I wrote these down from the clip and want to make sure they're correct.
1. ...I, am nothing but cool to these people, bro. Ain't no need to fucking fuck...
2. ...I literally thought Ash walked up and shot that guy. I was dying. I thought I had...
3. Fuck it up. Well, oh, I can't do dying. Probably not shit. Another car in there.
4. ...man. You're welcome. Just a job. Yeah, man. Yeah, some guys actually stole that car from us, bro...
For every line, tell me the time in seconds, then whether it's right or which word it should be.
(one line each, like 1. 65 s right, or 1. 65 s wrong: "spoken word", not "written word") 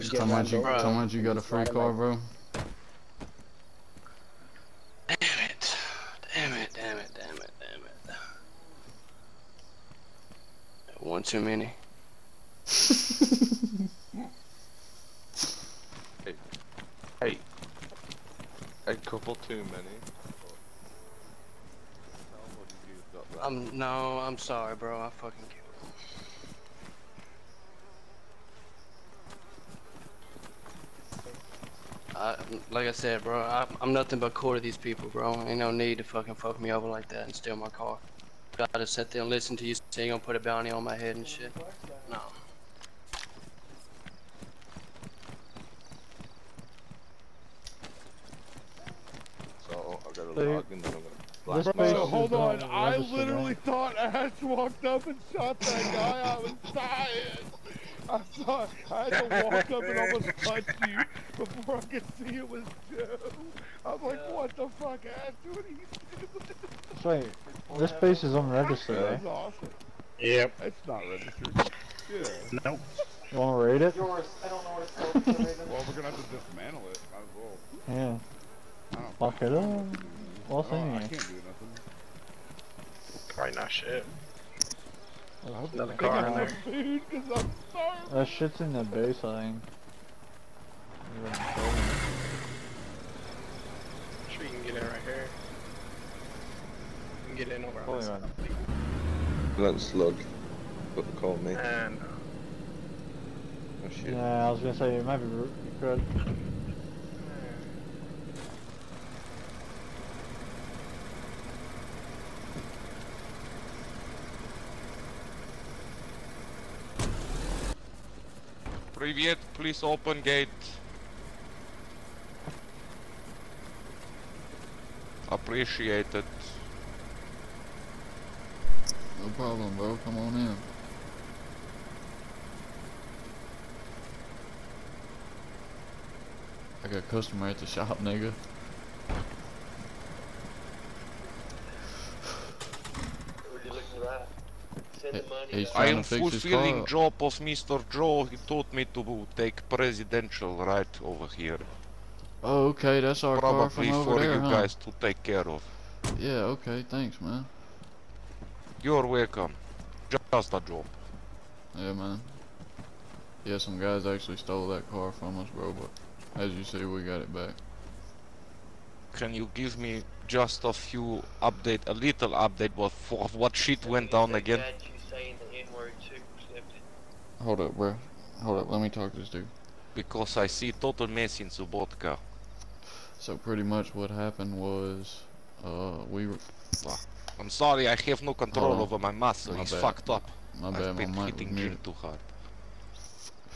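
1. 33 s right
2. 52 s right
3. 79 s wrong: "nothing", not "dying"
4. 157 s right.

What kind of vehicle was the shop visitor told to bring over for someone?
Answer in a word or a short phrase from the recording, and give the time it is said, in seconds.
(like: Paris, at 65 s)
presidential, at 149 s.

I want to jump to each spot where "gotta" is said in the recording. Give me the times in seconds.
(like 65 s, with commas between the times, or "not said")
38 s, 50 s.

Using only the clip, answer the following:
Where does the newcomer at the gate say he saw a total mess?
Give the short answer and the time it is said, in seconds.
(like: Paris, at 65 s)
Sobotka, at 181 s.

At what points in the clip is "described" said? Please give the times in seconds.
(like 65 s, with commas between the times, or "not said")
not said.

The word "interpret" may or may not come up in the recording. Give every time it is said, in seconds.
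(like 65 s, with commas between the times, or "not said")
not said.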